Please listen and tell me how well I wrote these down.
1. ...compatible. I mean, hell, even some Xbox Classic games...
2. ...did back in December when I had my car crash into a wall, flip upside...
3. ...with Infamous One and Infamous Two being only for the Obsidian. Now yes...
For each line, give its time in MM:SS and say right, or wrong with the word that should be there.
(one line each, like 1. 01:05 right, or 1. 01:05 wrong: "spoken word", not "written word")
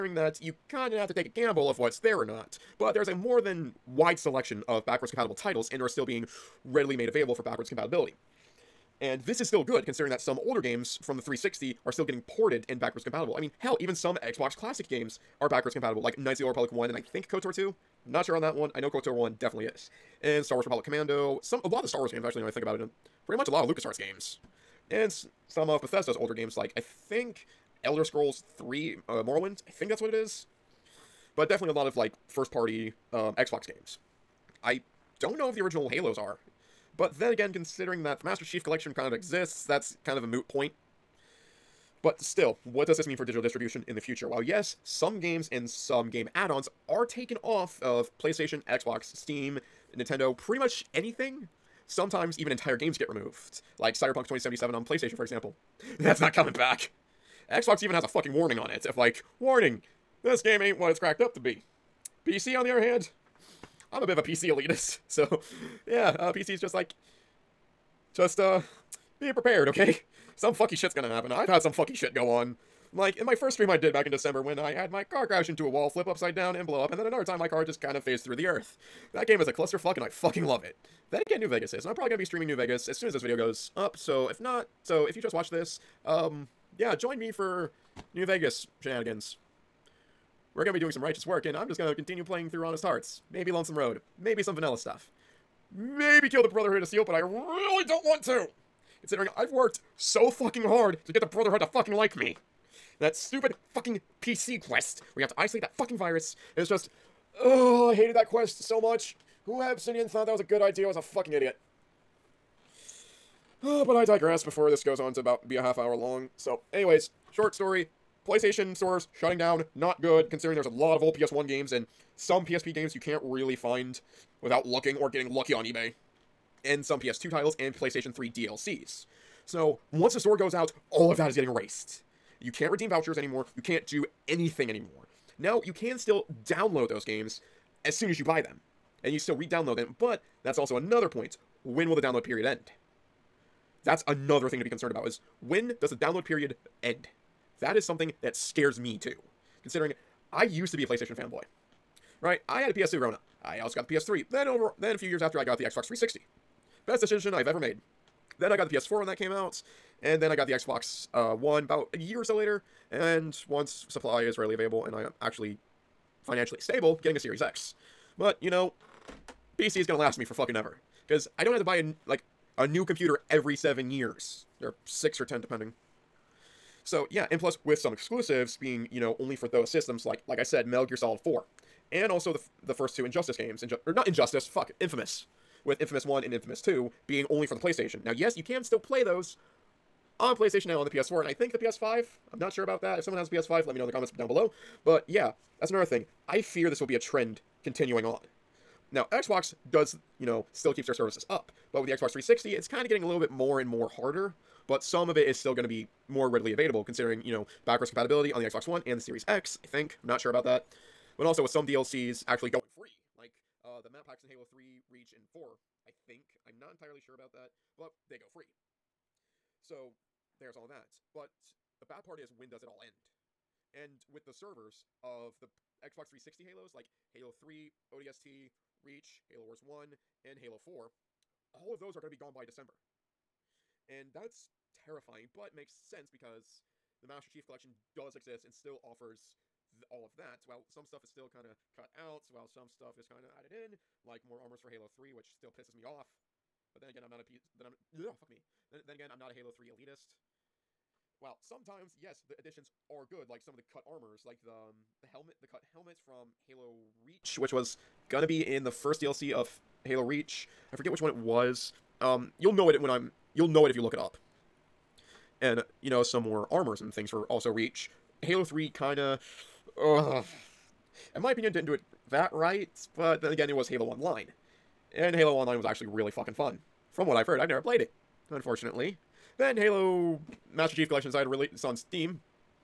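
1. 00:13 right
2. 01:13 right
3. 03:05 wrong: "PlayStation", not "Obsidian".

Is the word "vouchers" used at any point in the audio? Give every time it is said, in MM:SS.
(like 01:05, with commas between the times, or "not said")
02:12.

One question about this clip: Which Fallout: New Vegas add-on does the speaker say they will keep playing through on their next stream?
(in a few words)
Honest Hearts.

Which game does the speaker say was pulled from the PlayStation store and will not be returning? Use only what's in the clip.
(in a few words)
Cyberpunk 2077.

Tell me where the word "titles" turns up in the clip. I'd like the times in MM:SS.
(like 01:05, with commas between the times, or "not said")
00:05, 02:07.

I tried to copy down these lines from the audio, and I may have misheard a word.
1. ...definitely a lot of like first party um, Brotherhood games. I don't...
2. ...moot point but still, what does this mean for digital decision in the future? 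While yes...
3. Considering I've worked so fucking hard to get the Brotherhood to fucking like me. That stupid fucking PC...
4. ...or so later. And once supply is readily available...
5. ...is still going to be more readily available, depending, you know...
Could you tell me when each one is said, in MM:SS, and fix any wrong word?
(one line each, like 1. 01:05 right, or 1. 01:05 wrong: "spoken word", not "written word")
1. 00:31 wrong: "Xbox", not "Brotherhood"
2. 00:40 wrong: "distribution", not "decision"
3. 01:39 right
4. 02:42 right
5. 03:25 wrong: "considering", not "depending".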